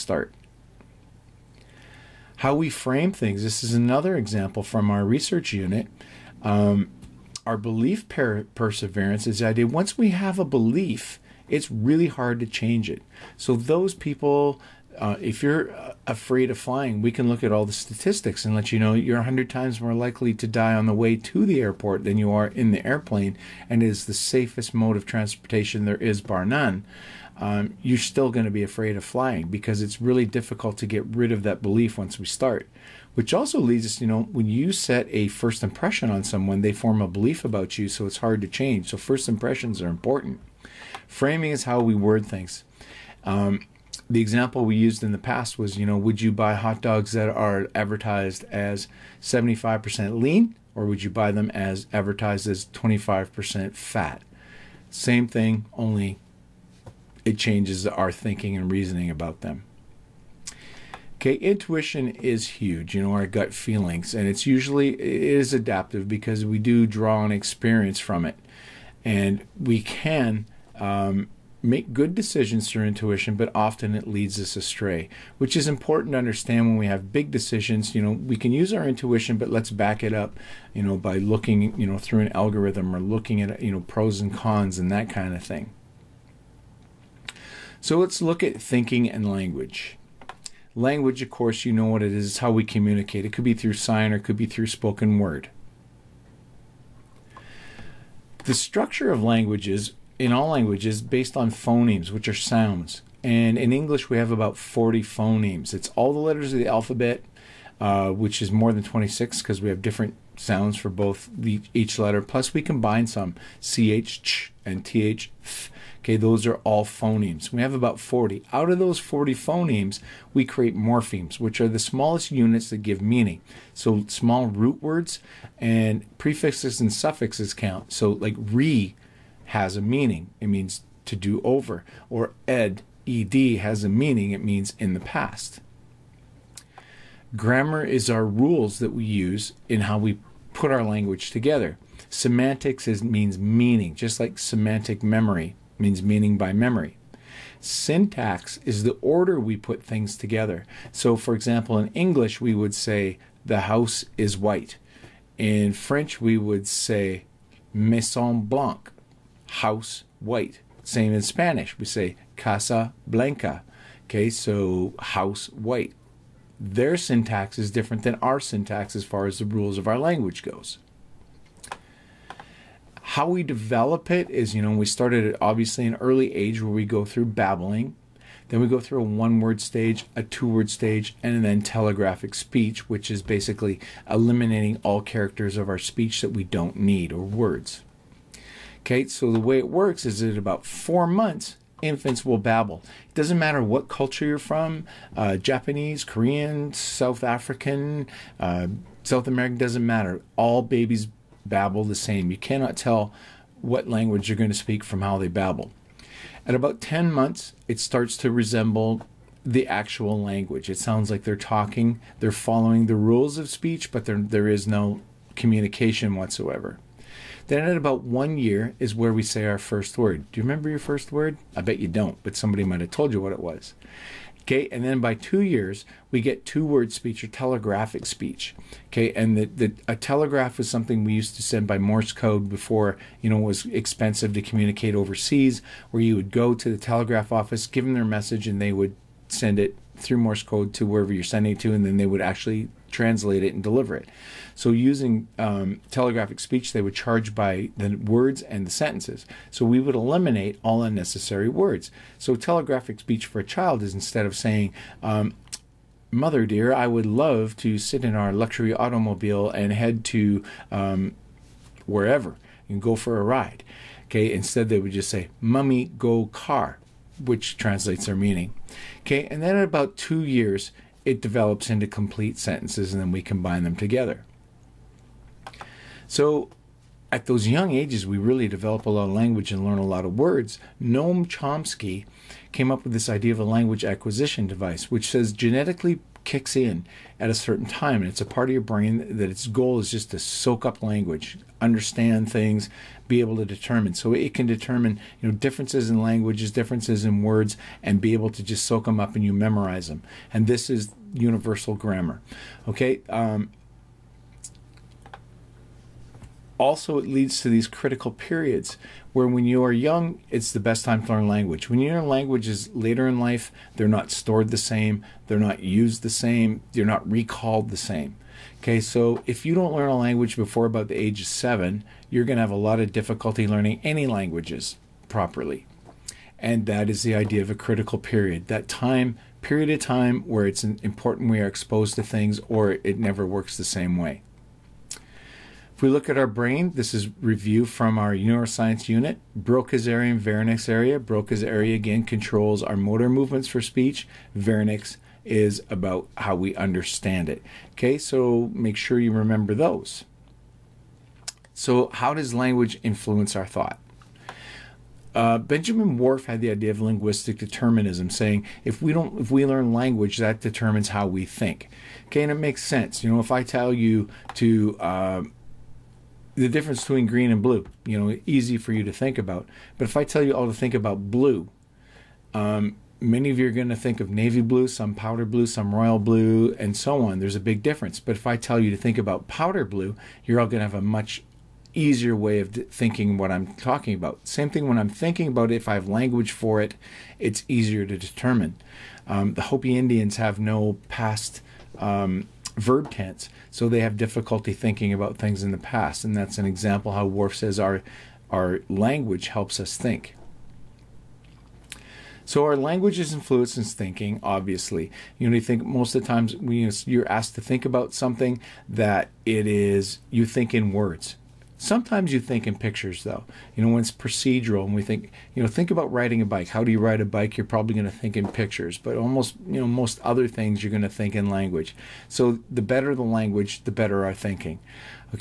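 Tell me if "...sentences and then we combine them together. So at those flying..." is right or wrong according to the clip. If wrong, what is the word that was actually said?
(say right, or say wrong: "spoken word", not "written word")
wrong: "young", not "flying".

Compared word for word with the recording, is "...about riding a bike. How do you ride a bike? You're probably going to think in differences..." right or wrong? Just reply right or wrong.
wrong.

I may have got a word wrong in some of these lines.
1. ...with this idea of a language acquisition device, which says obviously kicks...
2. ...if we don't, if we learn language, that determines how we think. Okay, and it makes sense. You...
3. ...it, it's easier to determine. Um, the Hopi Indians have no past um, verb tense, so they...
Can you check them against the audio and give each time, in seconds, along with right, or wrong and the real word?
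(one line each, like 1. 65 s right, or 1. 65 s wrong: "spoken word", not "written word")
1. 282 s wrong: "genetically", not "obviously"
2. 358 s right
3. 386 s right.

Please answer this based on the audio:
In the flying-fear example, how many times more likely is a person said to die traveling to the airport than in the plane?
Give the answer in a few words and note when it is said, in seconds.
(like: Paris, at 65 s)
100, at 19 s.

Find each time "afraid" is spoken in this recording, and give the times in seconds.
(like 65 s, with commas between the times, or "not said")
16 s, 28 s.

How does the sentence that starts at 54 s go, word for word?
Same thing, only it changes our thinking and reasoning about them.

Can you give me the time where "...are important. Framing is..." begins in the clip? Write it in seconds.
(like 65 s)
39 s.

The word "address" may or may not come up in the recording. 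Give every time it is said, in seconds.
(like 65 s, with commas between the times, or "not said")
not said.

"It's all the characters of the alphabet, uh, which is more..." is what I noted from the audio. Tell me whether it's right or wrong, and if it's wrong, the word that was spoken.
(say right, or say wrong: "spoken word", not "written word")
wrong: "letters", not "characters".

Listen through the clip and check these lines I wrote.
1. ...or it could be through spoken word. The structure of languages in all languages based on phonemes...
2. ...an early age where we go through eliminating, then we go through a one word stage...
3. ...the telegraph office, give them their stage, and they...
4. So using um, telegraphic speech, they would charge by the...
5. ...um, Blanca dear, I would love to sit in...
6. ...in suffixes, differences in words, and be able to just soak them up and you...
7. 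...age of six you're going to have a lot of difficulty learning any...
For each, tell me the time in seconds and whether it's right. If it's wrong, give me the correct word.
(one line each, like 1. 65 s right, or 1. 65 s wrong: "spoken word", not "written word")
1. 94 s right
2. 175 s wrong: "babbling", not "eliminating"
3. 236 s wrong: "message", not "stage"
4. 244 s right
5. 255 s wrong: "Mother", not "Blanca"
6. 295 s wrong: "languages", not "suffixes"
7. 320 s wrong: "seven", not "six".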